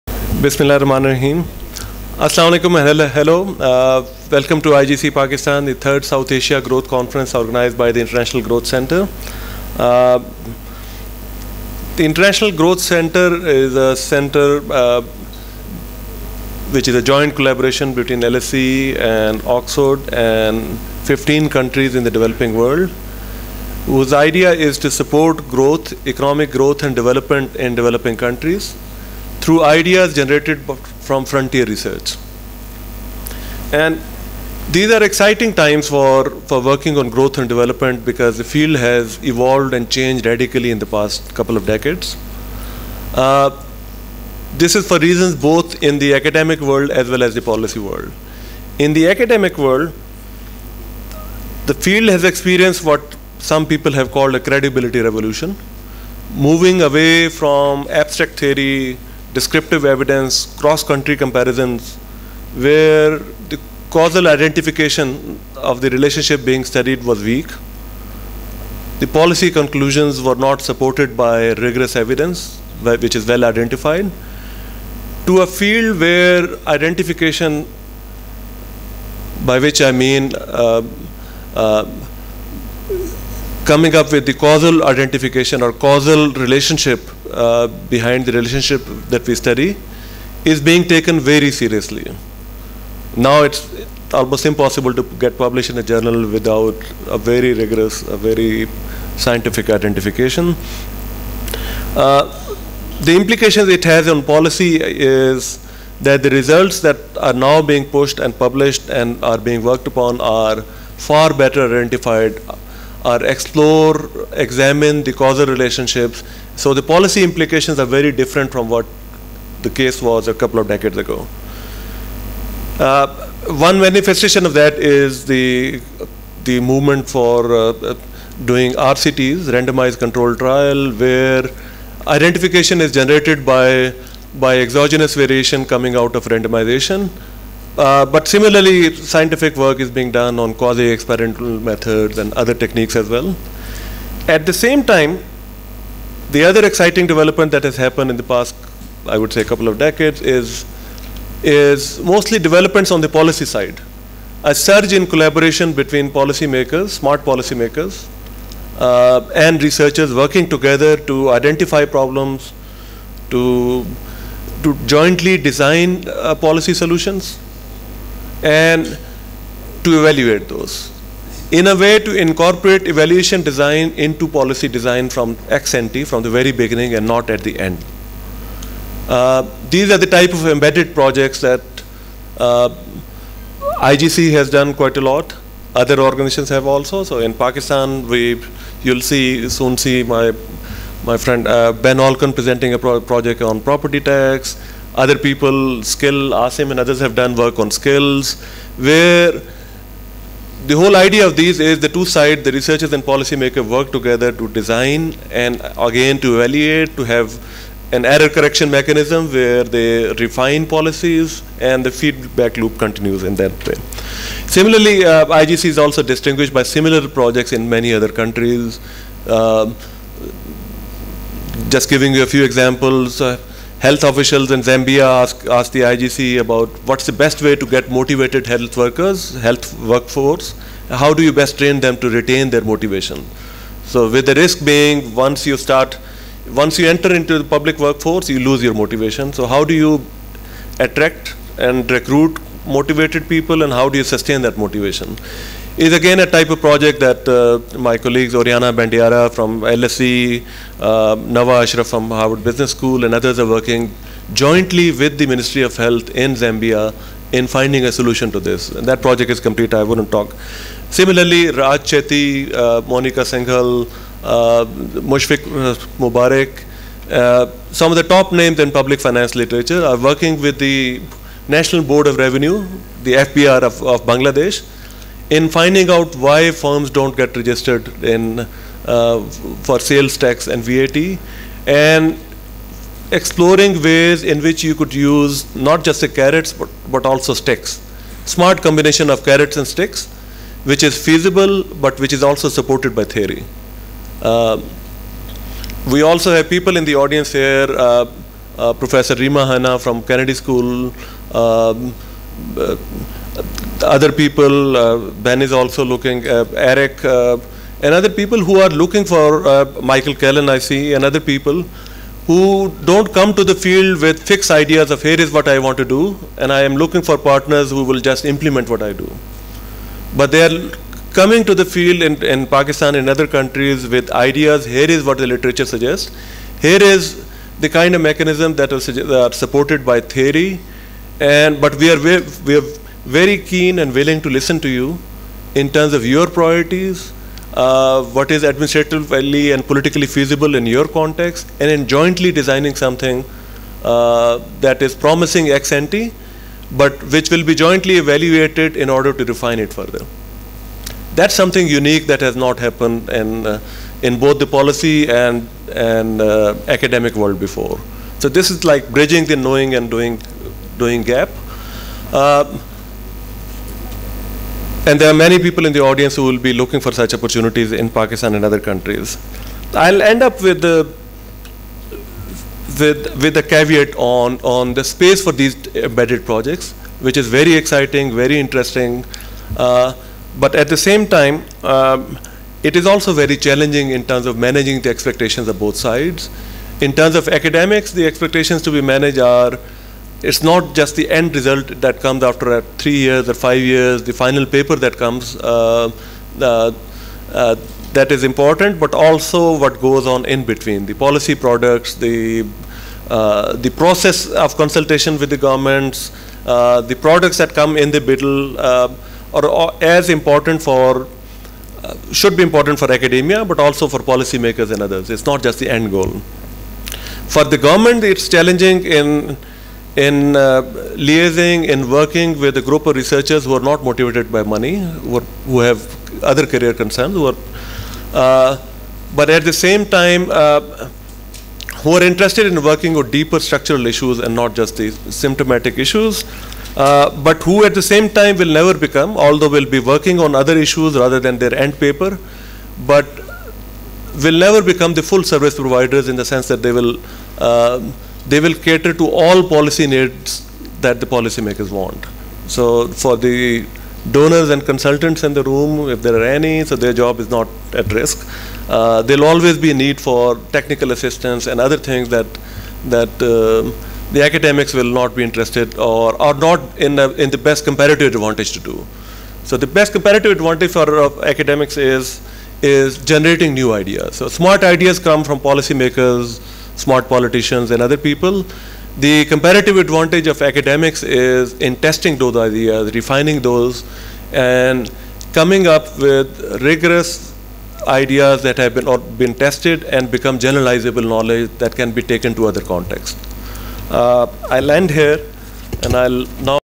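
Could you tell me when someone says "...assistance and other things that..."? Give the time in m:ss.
7:40.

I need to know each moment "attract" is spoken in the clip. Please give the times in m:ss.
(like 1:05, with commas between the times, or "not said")
4:00.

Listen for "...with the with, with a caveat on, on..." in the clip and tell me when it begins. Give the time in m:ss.
6:10.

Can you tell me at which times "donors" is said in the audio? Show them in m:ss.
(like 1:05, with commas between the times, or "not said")
7:34.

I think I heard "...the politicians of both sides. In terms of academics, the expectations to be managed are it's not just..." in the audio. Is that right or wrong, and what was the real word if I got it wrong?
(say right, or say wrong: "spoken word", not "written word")
wrong: "expectations", not "politicians".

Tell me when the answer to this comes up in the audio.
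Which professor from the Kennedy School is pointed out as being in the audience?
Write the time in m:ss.
4:59.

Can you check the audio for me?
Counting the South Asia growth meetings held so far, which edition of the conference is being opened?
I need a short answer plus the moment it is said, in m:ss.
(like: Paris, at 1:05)
third, at 0:05.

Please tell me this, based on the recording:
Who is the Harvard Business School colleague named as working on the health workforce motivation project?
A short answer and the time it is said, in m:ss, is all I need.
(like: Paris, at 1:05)
Nava Ashraf, at 4:11.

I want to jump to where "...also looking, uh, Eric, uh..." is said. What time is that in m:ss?
5:05.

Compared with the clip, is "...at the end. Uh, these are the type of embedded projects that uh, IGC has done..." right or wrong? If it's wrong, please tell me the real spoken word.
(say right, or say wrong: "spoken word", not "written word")
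right.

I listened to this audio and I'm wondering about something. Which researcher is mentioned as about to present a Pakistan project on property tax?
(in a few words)
Ben Olken.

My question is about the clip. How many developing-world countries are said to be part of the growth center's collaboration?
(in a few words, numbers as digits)
15.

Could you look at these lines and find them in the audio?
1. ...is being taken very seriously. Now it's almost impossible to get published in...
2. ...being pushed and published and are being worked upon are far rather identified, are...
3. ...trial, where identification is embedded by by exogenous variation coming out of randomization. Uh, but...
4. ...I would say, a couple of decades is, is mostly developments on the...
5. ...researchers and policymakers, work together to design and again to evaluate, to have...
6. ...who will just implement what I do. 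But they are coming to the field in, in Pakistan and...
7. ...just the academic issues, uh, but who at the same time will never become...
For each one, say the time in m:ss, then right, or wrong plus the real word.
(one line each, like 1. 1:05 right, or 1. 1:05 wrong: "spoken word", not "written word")
1. 1:30 right
2. 1:47 wrong: "better", not "rather"
3. 2:10 wrong: "generated", not "embedded"
4. 2:29 right
5. 3:22 right
6. 5:17 right
7. 7:14 wrong: "symptomatic", not "academic".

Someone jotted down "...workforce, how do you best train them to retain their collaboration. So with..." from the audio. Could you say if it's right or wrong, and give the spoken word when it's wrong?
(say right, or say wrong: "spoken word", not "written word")
wrong: "motivation", not "collaboration".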